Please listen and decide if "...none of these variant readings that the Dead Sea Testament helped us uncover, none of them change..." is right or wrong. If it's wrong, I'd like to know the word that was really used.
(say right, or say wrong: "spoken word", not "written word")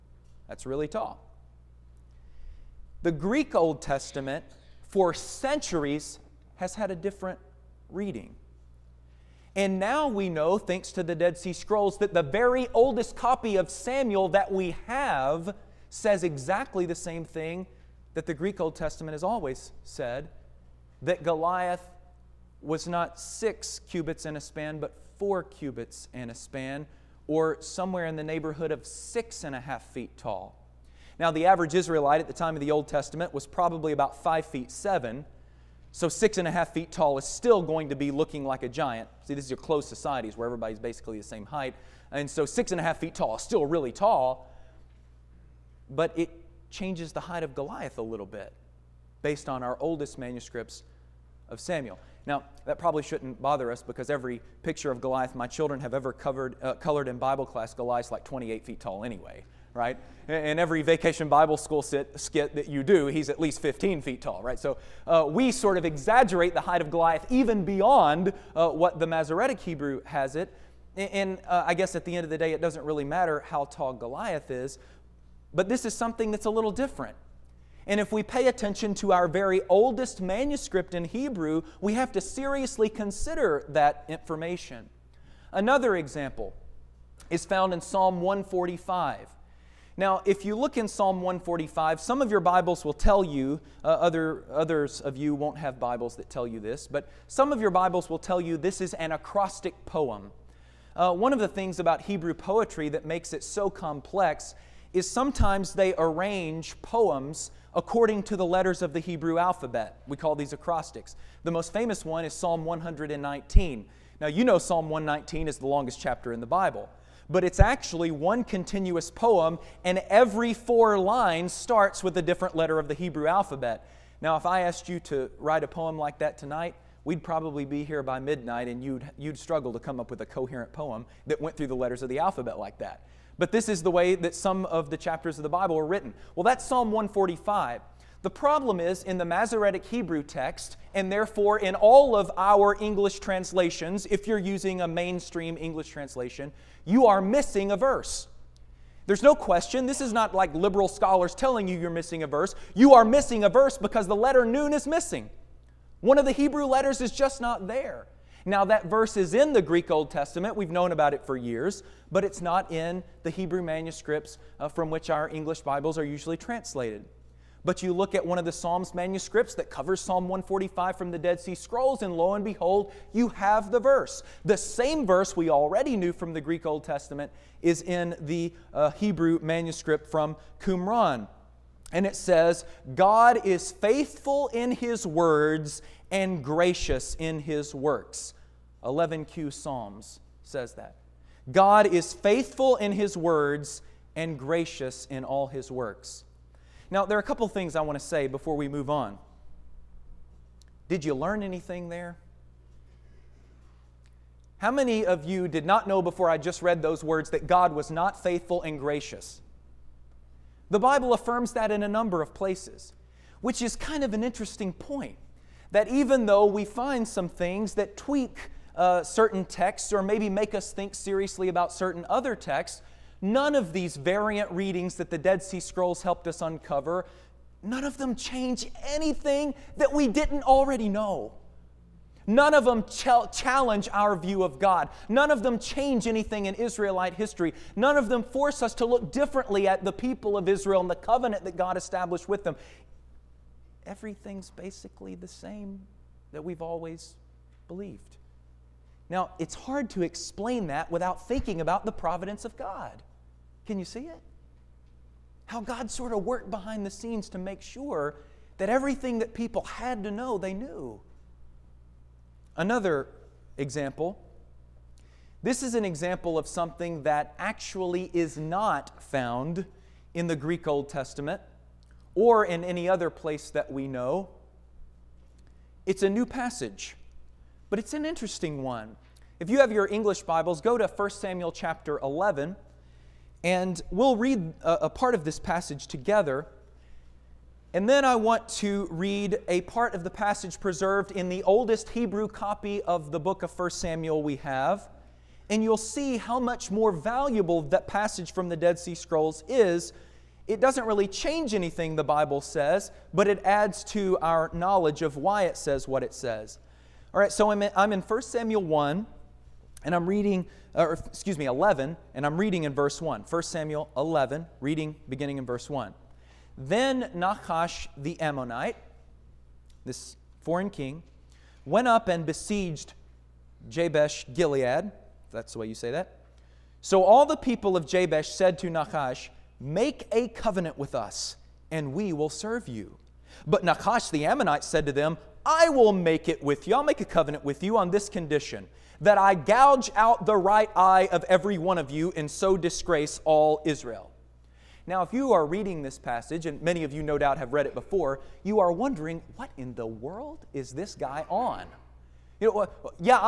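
wrong: "Scrolls", not "Testament".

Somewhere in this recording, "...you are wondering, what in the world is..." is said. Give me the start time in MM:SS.
05:48.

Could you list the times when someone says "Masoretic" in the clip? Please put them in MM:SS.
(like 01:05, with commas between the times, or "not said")
01:09, 02:19.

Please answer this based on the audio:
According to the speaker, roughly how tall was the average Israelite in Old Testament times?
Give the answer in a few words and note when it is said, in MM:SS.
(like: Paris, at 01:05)
5 feet 7, at 00:34.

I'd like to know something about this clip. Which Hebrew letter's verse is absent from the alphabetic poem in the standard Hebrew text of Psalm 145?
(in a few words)
noon.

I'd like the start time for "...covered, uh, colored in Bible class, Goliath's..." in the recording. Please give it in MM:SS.
00:56.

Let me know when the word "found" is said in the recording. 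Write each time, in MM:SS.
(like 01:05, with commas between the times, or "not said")
01:27, 04:29.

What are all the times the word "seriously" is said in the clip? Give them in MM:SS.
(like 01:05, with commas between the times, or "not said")
01:22, 03:40.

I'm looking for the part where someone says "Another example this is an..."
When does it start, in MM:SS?
04:22.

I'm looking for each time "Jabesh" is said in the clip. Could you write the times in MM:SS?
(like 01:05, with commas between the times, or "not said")
05:23, 05:27.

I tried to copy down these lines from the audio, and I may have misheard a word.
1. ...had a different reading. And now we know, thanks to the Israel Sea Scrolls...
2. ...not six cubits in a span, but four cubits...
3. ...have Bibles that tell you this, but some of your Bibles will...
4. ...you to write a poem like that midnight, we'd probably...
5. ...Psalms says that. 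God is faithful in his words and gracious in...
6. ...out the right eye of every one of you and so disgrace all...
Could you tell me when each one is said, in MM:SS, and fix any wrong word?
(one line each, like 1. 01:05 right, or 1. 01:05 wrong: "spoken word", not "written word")
1. 00:06 wrong: "Dead", not "Israel"
2. 00:22 right
3. 01:35 right
4. 02:04 wrong: "tonight", not "midnight"
5. 03:09 right
6. 05:39 right.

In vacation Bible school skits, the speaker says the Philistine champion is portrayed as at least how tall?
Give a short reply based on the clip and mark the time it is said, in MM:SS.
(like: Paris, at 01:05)
15 feet, at 01:03.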